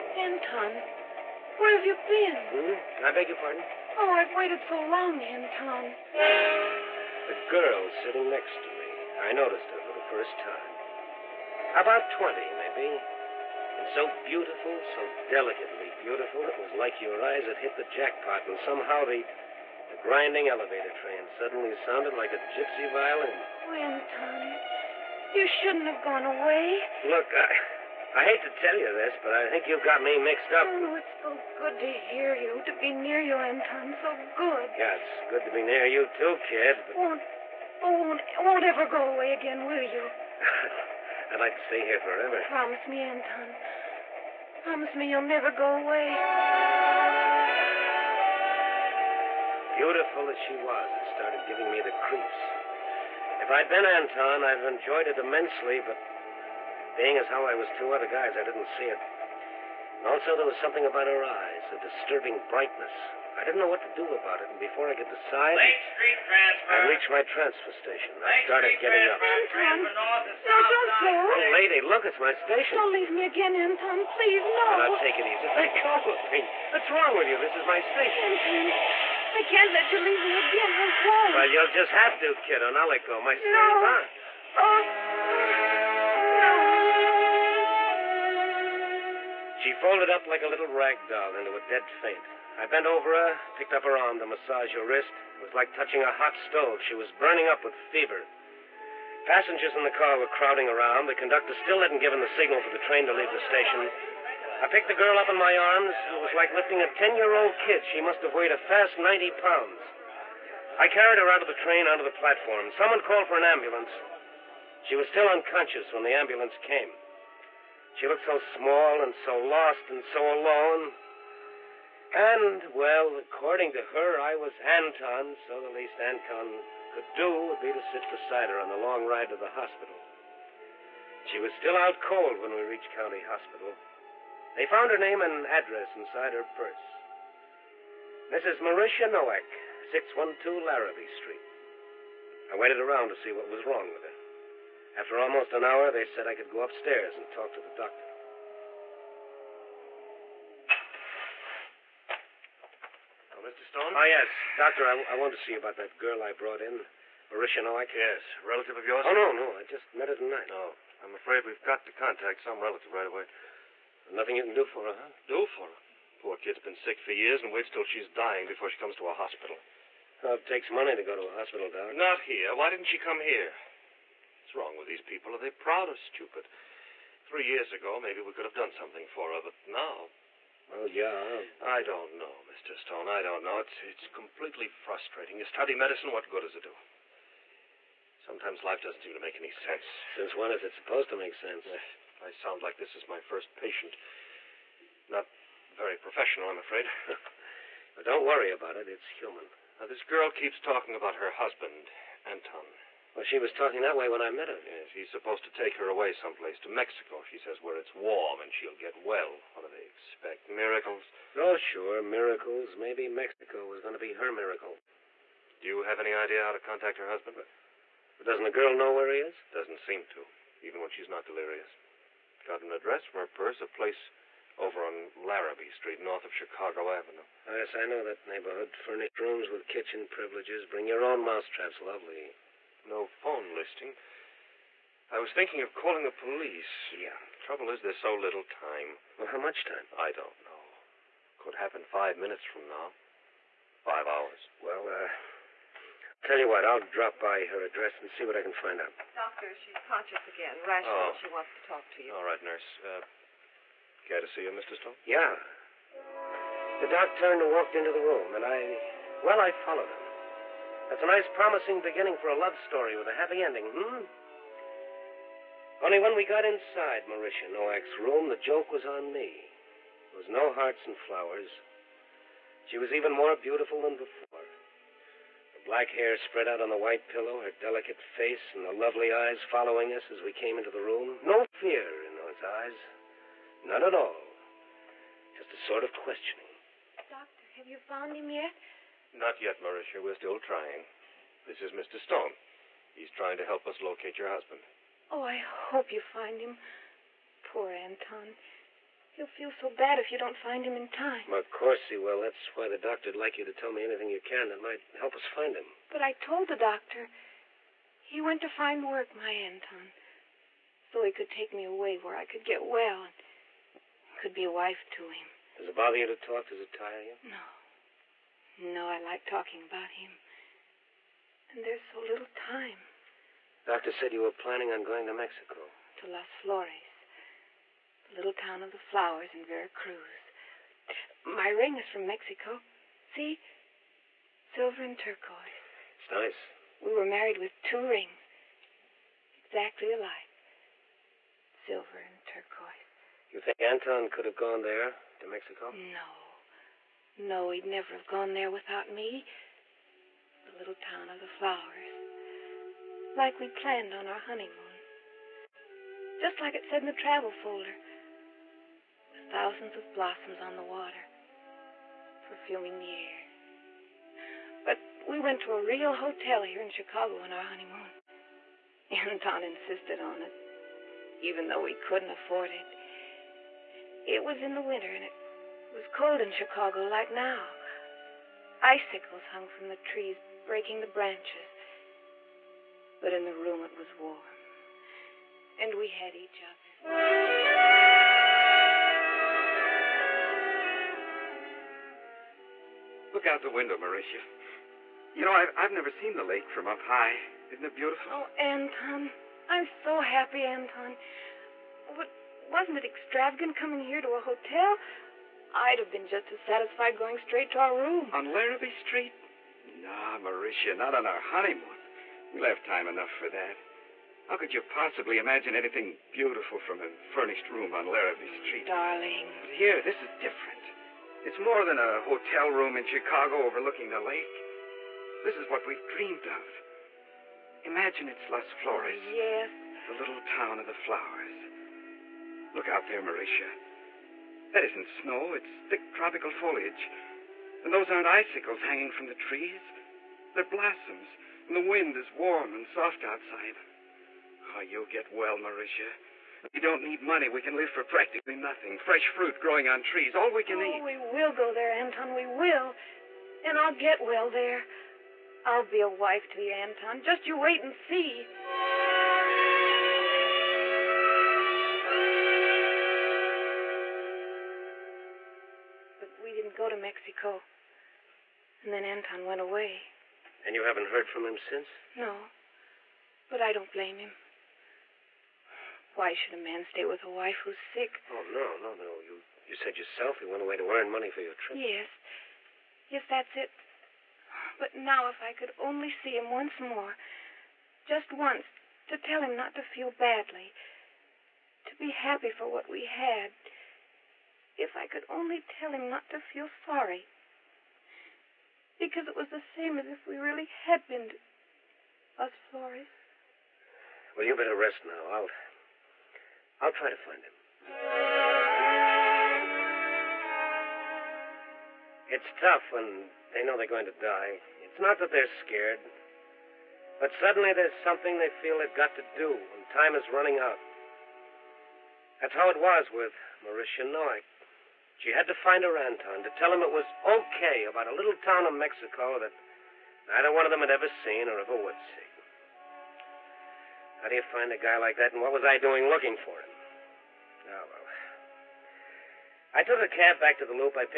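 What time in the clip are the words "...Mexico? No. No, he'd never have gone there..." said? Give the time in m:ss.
5:45.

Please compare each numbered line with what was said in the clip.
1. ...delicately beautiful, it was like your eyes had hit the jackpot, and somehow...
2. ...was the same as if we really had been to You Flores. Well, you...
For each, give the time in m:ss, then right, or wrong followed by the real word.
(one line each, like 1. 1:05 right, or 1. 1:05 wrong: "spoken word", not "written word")
1. 0:15 right
2. 8:19 wrong: "Las", not "You".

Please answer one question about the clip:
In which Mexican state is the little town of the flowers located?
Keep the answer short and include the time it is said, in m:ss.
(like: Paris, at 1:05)
Veracruz, at 5:29.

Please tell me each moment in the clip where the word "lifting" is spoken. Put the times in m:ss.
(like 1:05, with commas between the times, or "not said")
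1:46.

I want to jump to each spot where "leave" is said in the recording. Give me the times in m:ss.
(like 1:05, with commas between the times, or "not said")
1:12, 1:19, 1:43.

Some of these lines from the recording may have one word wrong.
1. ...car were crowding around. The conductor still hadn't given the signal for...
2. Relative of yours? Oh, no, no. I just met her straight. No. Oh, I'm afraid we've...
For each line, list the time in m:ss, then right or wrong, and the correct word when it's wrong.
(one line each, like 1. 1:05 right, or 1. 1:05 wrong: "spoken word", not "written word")
1. 1:39 right
2. 2:38 wrong: "tonight", not "straight".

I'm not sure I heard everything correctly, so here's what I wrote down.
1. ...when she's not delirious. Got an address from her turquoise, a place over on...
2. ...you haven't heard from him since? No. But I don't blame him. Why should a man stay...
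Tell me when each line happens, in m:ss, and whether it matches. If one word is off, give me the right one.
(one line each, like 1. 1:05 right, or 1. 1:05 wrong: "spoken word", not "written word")
1. 3:40 wrong: "purse", not "turquoise"
2. 7:50 right.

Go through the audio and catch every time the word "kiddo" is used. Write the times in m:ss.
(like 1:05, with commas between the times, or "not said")
1:22.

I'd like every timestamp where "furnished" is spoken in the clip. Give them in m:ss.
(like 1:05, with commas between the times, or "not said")
3:48, 6:57.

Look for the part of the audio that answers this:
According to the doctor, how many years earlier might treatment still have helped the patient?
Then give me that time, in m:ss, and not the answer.
2:57.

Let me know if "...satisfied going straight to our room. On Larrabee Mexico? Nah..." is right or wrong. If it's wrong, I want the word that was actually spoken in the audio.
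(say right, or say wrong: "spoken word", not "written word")
wrong: "Street", not "Mexico".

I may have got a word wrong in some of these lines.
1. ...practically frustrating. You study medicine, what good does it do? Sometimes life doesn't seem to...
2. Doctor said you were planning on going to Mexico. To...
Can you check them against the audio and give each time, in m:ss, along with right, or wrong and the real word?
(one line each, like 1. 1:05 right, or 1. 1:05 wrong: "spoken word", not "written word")
1. 3:04 wrong: "completely", not "practically"
2. 5:23 right.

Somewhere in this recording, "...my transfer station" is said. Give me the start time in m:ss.
1:07.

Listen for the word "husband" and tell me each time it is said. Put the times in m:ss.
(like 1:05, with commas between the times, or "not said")
3:21, 3:37, 4:54.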